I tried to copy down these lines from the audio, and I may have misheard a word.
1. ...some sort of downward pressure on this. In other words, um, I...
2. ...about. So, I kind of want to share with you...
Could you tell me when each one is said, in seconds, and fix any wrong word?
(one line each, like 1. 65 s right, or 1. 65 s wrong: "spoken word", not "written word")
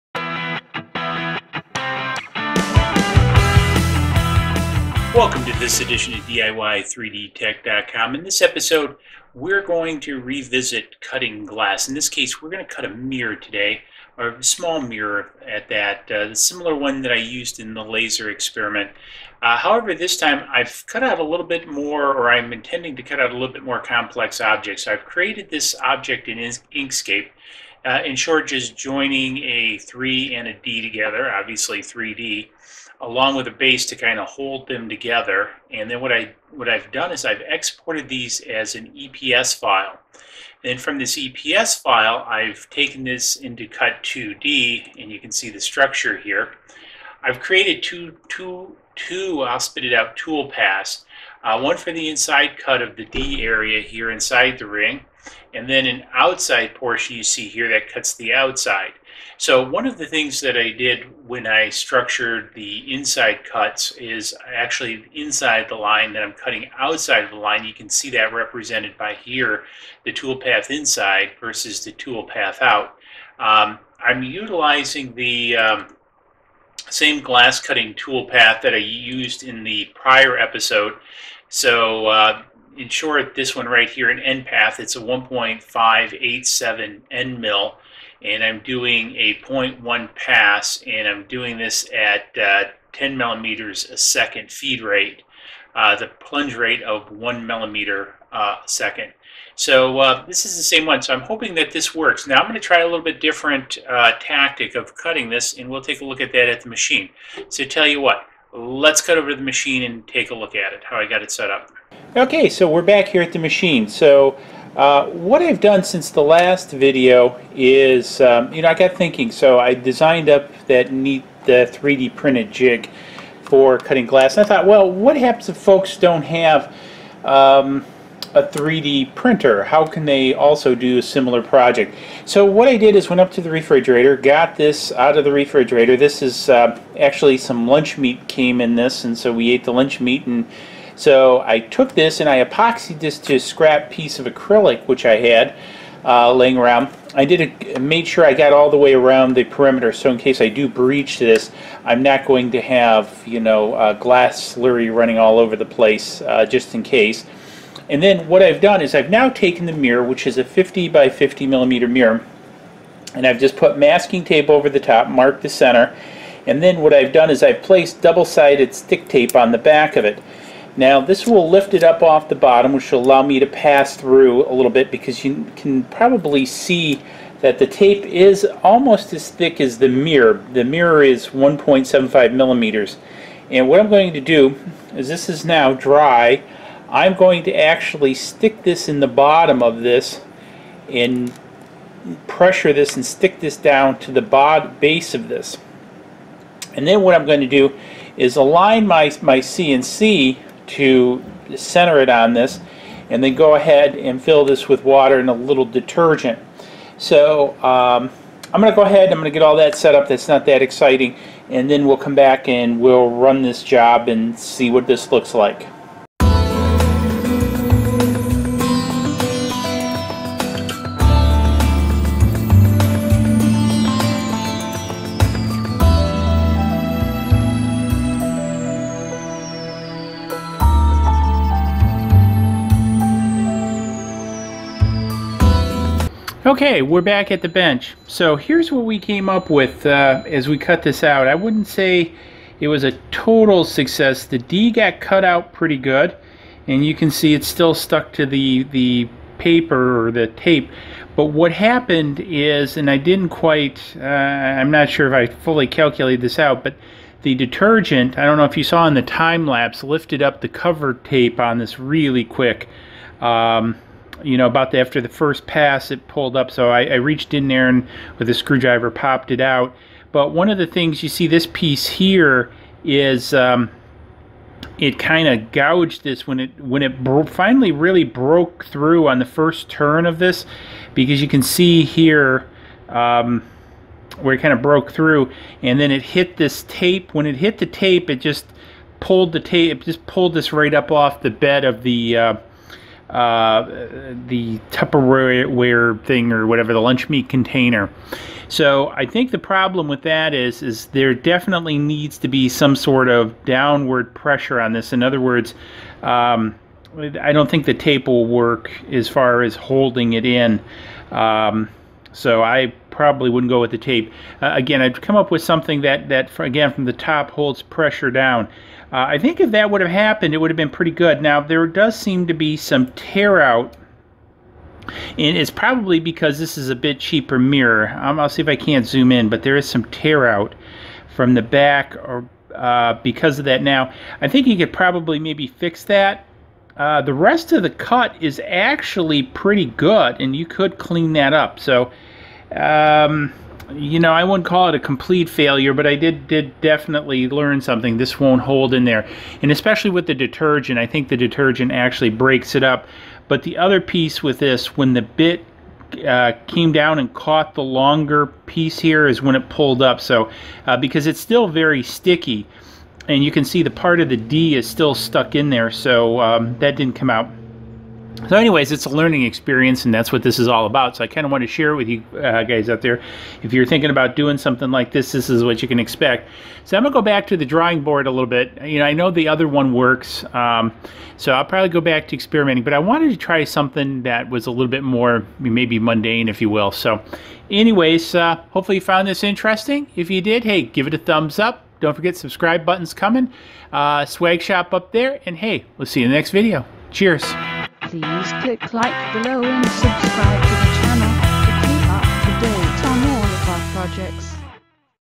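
1. 302 s right
2. 370 s right.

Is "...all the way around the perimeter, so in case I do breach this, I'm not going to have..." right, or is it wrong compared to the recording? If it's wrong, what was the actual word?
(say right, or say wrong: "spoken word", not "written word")
right.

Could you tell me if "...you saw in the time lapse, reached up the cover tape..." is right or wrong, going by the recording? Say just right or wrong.
wrong.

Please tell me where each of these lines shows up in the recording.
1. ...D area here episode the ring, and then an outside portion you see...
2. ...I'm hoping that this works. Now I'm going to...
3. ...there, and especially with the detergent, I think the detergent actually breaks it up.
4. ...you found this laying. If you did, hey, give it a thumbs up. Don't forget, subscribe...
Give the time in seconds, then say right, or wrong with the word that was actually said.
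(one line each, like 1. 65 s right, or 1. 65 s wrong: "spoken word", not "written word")
1. 53 s wrong: "inside", not "episode"
2. 101 s right
3. 348 s right
4. 388 s wrong: "interesting", not "laying".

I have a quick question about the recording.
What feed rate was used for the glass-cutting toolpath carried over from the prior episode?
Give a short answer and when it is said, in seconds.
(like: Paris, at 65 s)
10 millimeters a second, at 92 s.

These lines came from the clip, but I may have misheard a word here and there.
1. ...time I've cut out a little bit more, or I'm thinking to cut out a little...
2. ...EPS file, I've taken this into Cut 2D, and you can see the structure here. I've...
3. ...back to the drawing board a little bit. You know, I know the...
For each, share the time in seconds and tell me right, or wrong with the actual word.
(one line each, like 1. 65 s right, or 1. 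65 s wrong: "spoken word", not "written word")
1. 20 s wrong: "intending", not "thinking"
2. 41 s right
3. 377 s right.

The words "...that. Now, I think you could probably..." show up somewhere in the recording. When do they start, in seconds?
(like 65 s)
333 s.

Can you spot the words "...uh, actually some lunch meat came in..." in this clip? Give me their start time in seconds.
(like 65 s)
136 s.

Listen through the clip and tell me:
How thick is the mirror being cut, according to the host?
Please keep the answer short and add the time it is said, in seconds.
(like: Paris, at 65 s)
1.75 millimeters, at 181 s.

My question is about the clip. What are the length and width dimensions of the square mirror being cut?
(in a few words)
50 by 50 millimeters.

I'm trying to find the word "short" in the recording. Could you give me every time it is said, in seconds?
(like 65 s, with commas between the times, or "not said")
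28 s, 82 s.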